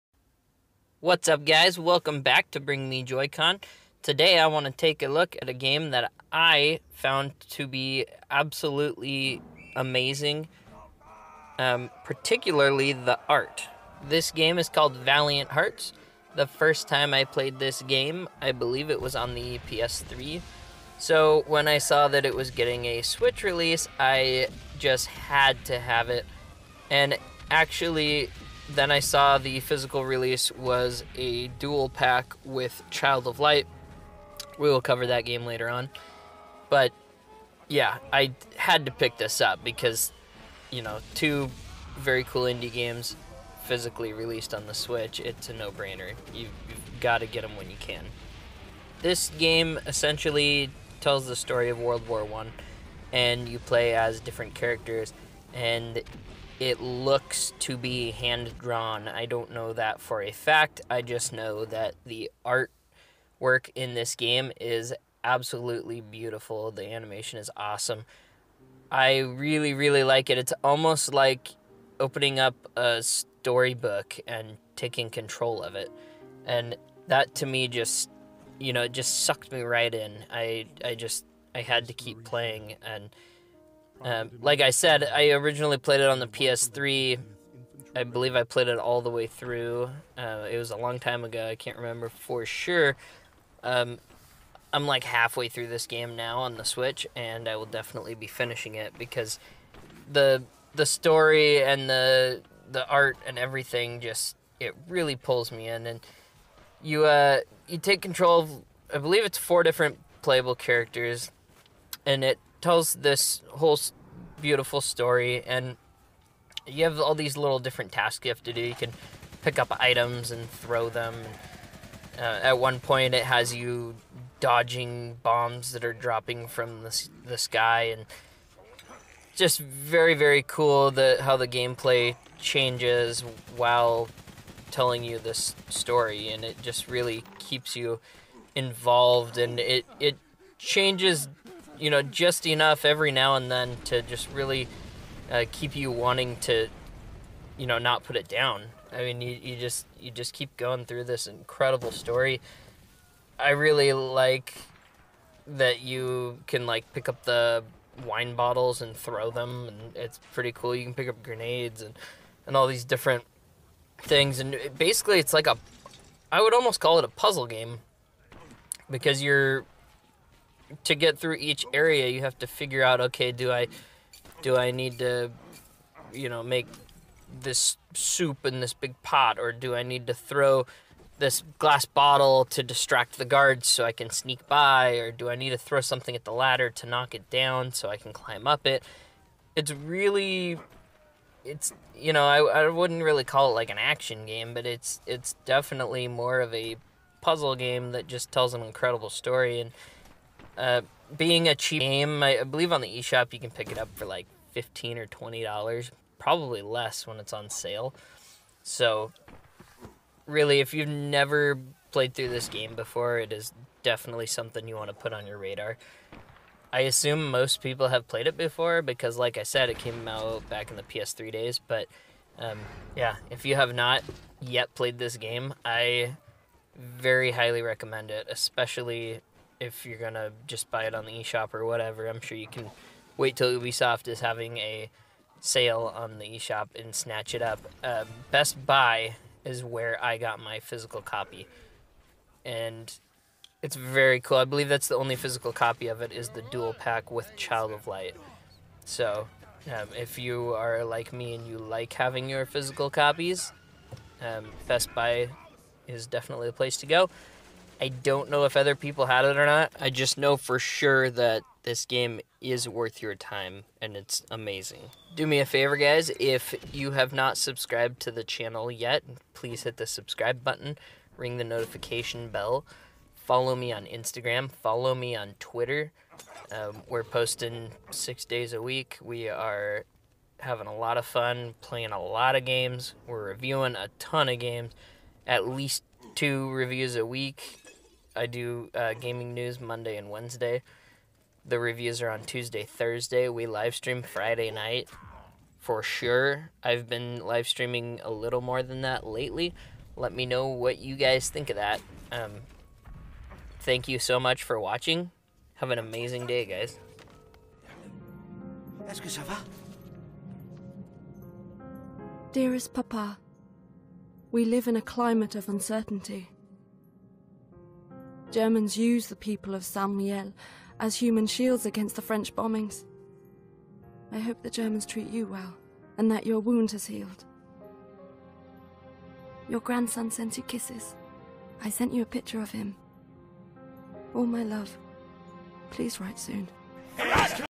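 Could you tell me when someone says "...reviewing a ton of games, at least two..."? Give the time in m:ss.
4:43.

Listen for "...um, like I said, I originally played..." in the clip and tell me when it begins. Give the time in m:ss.
1:24.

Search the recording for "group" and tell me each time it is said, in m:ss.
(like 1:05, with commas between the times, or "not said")
not said.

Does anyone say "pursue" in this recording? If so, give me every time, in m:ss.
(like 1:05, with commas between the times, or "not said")
not said.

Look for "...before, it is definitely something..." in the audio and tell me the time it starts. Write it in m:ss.
3:32.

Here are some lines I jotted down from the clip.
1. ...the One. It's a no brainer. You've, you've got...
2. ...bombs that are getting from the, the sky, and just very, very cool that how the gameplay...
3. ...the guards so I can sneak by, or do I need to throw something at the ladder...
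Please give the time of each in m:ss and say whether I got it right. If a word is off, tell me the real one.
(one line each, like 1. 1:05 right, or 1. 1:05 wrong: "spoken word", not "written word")
1. 0:44 wrong: "Switch", not "One"
2. 2:05 wrong: "dropping", not "getting"
3. 3:03 right.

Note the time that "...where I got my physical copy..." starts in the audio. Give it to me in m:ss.
3:59.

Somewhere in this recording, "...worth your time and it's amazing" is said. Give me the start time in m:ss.
4:22.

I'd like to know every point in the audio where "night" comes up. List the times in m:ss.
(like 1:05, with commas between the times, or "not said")
4:54.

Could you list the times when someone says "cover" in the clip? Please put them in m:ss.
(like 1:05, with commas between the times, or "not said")
0:34.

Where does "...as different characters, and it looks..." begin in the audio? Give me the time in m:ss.
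0:53.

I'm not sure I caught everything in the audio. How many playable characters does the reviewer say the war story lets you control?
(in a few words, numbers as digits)
4.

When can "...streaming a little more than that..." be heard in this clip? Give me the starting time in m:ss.
4:57.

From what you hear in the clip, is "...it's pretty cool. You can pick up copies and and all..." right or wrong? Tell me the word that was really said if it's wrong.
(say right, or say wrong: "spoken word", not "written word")
wrong: "grenades", not "copies".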